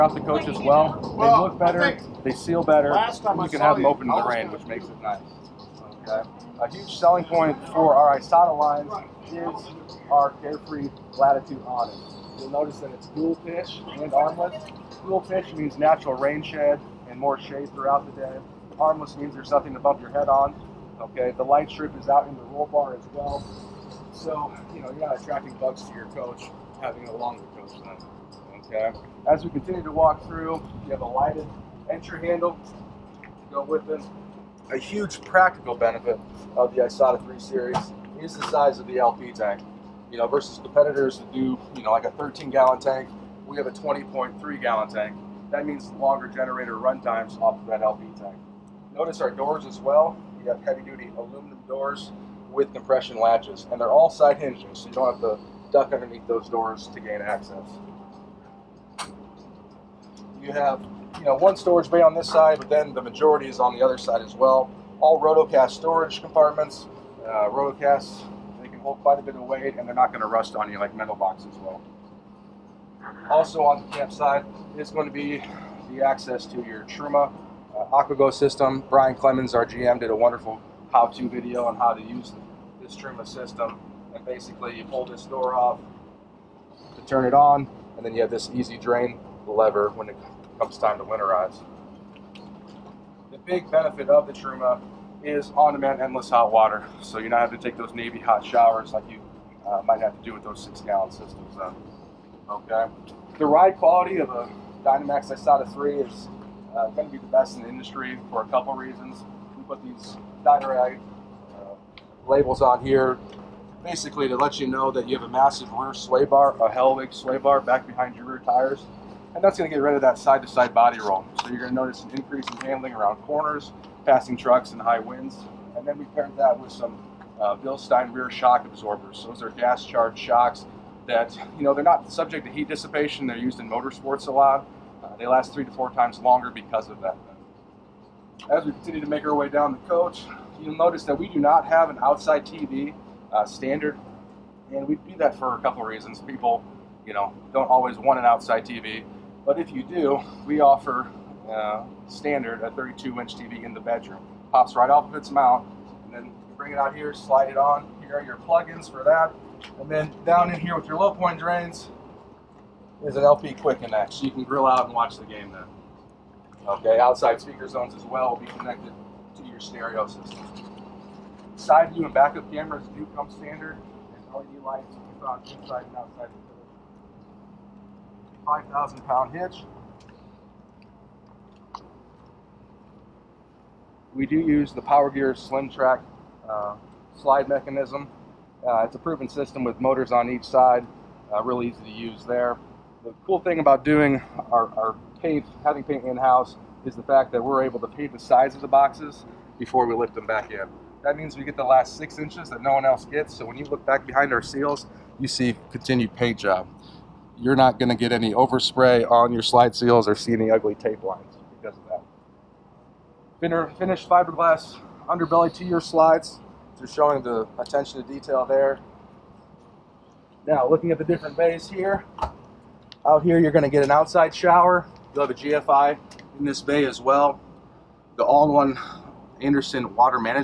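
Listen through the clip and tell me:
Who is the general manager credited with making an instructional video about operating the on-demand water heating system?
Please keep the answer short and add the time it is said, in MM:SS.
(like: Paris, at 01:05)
Brian Clemens, at 01:18.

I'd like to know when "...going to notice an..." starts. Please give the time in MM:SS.
02:01.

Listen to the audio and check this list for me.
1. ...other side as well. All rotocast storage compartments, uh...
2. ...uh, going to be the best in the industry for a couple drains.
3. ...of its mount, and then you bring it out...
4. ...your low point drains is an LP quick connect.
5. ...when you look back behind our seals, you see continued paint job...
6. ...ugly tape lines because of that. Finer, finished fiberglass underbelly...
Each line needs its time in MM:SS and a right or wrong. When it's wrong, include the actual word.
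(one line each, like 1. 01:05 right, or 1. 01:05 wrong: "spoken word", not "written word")
1. 01:03 right
2. 01:46 wrong: "reasons", not "drains"
3. 02:35 right
4. 02:40 right
5. 03:23 right
6. 03:30 right.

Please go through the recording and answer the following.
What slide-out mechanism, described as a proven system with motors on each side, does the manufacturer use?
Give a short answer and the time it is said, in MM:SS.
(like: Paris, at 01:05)
Power Gear Slim Track, at 03:04.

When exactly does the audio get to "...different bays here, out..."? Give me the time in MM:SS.
03:41.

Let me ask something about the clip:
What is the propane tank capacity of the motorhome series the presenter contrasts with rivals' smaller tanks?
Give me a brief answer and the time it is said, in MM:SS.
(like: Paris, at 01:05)
20.3 gallons, at 00:43.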